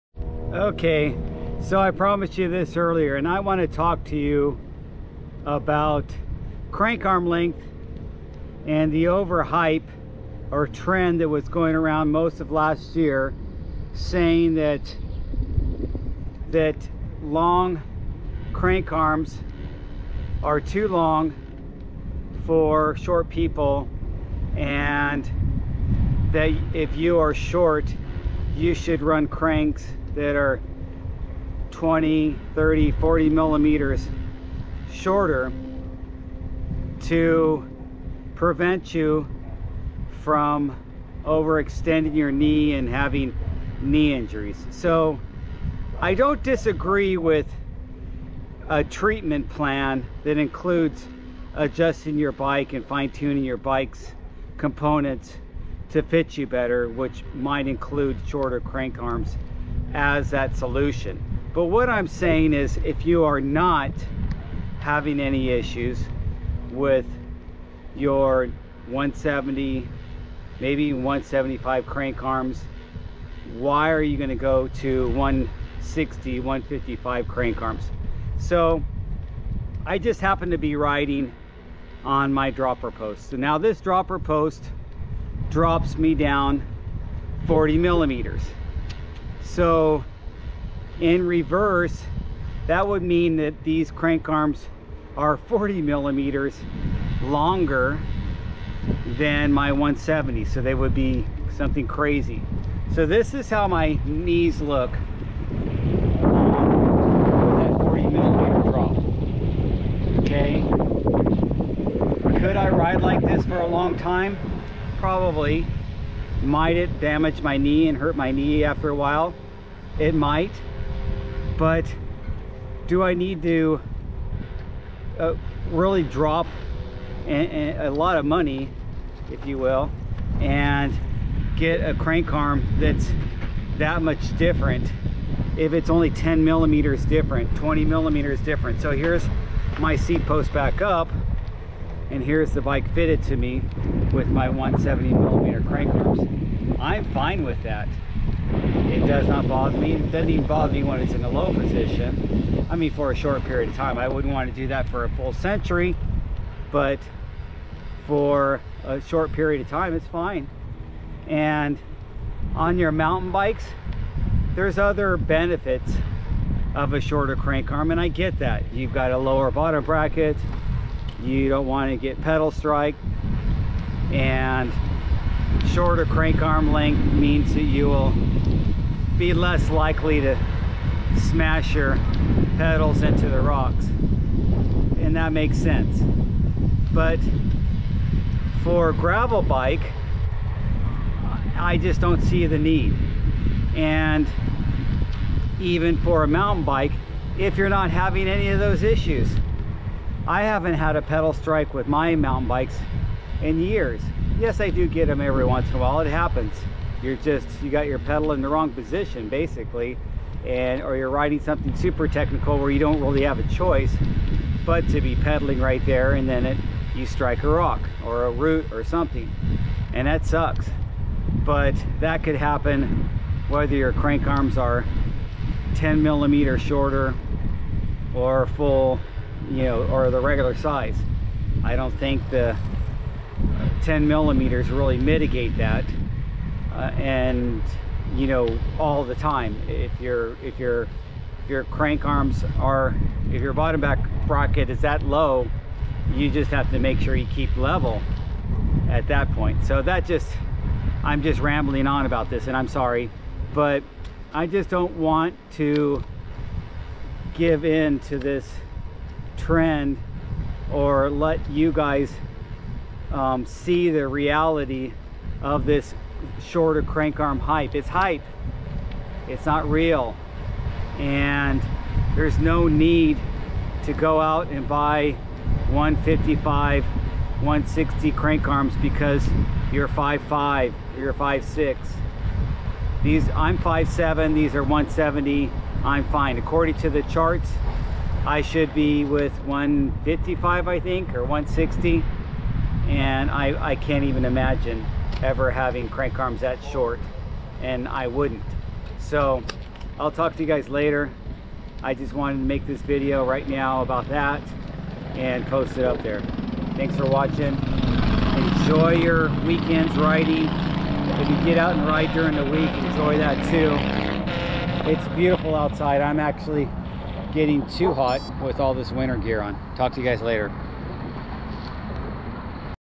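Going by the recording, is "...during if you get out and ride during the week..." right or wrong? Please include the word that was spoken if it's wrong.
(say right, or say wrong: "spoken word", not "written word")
wrong: "riding", not "during".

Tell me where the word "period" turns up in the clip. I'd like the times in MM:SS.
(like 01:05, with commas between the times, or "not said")
02:33, 02:39.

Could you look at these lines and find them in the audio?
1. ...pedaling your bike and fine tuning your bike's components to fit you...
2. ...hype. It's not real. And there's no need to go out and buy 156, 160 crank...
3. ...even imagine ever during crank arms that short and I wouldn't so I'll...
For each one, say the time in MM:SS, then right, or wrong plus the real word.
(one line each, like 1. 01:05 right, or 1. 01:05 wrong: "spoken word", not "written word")
1. 00:51 wrong: "adjusting", not "pedaling"
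2. 04:27 wrong: "155", not "156"
3. 04:54 wrong: "having", not "during".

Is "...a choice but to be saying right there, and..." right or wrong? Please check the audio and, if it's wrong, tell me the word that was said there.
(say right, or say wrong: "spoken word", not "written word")
wrong: "pedaling", not "saying".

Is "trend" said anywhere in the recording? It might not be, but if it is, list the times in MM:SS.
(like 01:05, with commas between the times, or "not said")
00:10, 04:19.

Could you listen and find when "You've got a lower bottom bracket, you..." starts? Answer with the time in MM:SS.
02:48.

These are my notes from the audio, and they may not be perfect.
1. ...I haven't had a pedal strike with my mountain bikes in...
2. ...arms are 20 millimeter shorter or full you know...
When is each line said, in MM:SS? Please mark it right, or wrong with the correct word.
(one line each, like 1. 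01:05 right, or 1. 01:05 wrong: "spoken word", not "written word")
1. 03:20 right
2. 03:44 wrong: "10", not "20".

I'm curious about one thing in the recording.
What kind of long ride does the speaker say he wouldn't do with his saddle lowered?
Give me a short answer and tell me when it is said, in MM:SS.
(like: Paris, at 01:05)
Century, at 02:35.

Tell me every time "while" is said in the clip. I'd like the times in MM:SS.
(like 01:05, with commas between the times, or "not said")
01:58, 03:25.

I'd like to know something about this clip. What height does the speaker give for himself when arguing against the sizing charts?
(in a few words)
5'7".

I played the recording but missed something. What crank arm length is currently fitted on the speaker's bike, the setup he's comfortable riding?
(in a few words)
170 mm.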